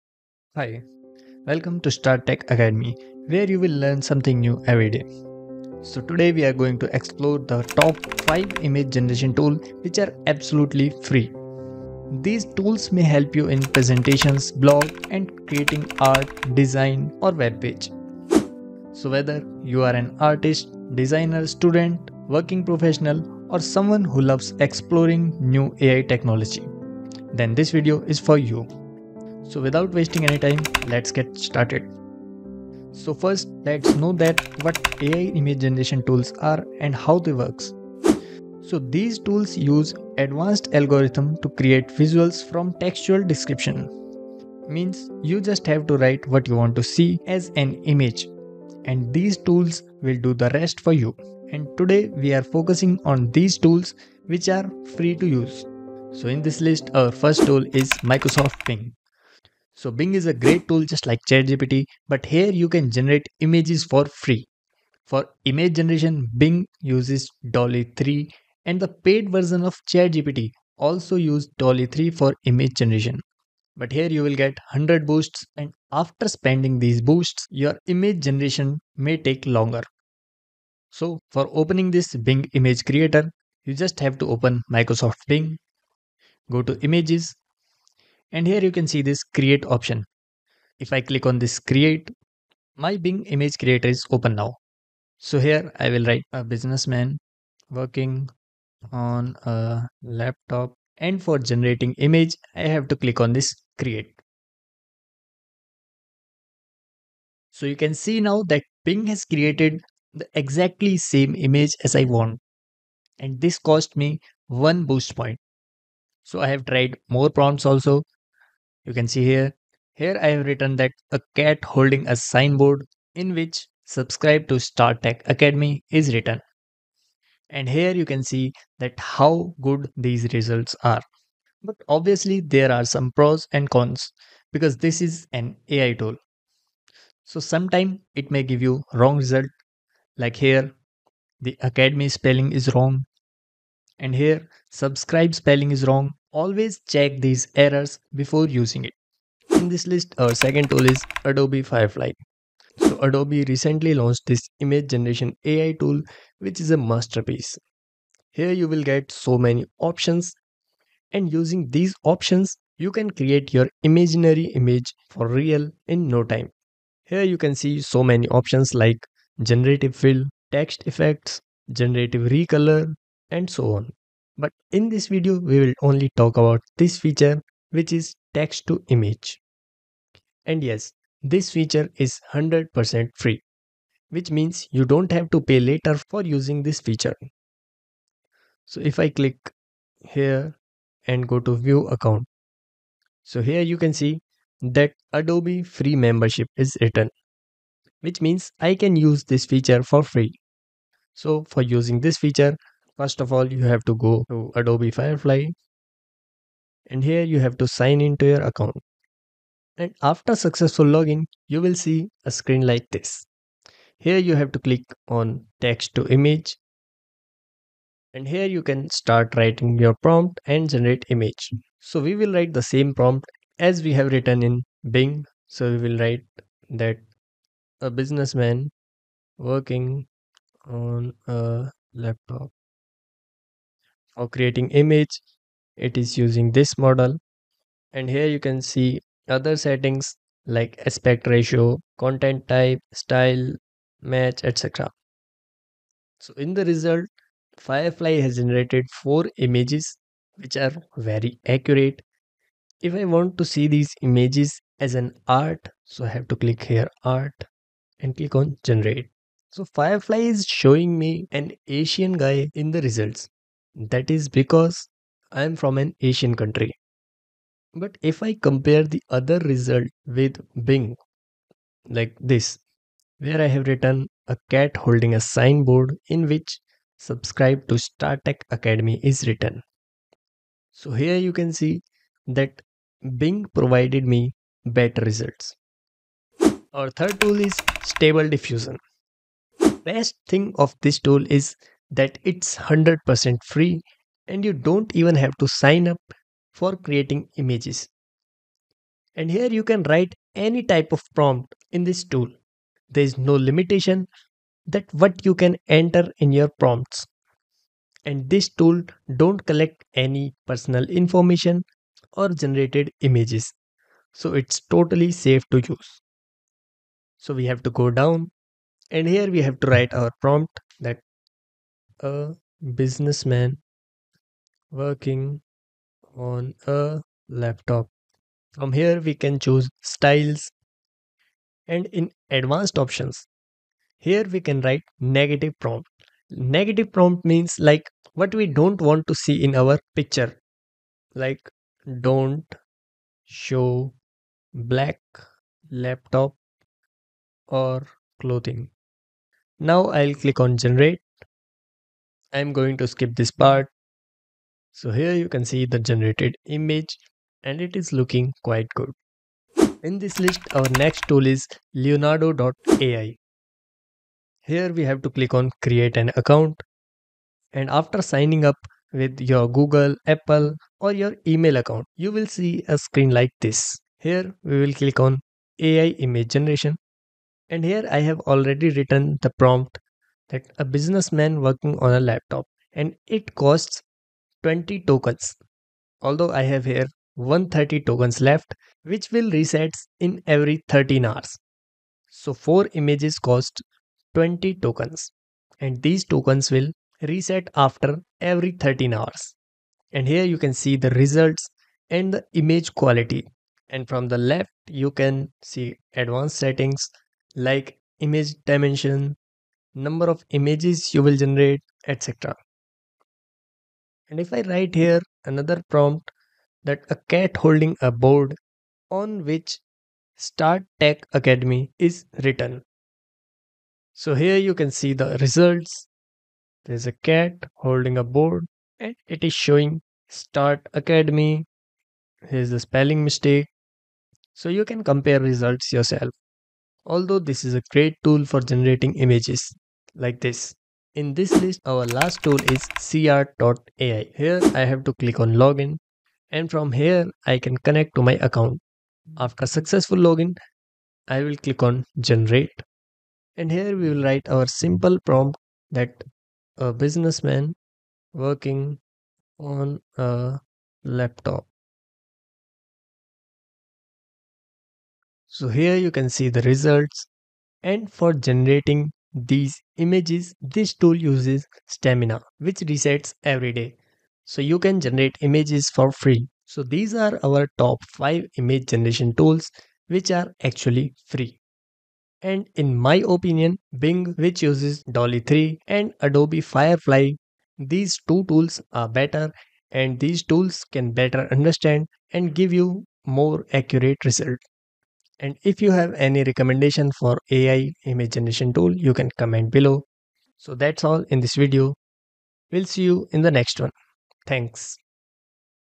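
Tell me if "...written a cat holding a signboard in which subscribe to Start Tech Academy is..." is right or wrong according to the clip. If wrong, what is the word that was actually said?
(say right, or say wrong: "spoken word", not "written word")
right.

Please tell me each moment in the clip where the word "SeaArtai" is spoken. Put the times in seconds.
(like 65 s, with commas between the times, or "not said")
442 s.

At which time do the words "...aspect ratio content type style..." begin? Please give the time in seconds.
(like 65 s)
240 s.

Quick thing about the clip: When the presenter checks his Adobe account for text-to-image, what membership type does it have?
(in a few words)
Adobe free membership.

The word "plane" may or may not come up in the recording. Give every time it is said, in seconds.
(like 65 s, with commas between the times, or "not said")
not said.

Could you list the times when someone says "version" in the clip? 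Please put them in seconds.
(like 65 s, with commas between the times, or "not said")
69 s.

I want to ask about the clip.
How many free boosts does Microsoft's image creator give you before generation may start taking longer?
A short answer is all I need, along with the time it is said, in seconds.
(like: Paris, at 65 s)
100, at 74 s.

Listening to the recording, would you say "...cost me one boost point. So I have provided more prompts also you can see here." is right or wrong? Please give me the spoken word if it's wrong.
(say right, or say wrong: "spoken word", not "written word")
wrong: "tried", not "provided".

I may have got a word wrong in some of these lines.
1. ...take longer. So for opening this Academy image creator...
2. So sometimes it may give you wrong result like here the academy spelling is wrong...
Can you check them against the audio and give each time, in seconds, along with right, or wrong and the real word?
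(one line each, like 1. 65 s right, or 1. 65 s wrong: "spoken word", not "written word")
1. 79 s wrong: "Bing", not "Academy"
2. 137 s right.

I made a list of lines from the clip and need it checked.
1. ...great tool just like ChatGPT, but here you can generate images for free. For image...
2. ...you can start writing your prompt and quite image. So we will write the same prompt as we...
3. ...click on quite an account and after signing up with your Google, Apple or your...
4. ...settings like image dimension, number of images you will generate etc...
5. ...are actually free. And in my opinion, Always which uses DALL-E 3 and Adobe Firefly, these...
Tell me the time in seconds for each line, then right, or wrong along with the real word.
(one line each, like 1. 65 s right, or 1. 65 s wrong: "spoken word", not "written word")
1. 60 s right
2. 218 s wrong: "generate", not "quite"
3. 365 s wrong: "create", not "quite"
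4. 406 s right
5. 480 s wrong: "Bing", not "Always".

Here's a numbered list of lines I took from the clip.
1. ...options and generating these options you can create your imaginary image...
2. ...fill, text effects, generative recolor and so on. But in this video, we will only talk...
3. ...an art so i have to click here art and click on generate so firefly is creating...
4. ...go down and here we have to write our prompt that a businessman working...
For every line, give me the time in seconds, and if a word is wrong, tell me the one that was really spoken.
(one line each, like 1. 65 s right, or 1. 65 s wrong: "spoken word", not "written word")
1. 159 s wrong: "using", not "generating"
2. 169 s right
3. 254 s wrong: "showing", not "creating"
4. 317 s right.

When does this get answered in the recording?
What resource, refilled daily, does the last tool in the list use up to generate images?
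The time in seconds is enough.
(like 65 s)
471 s.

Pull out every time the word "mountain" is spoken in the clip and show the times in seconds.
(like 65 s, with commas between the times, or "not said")
not said.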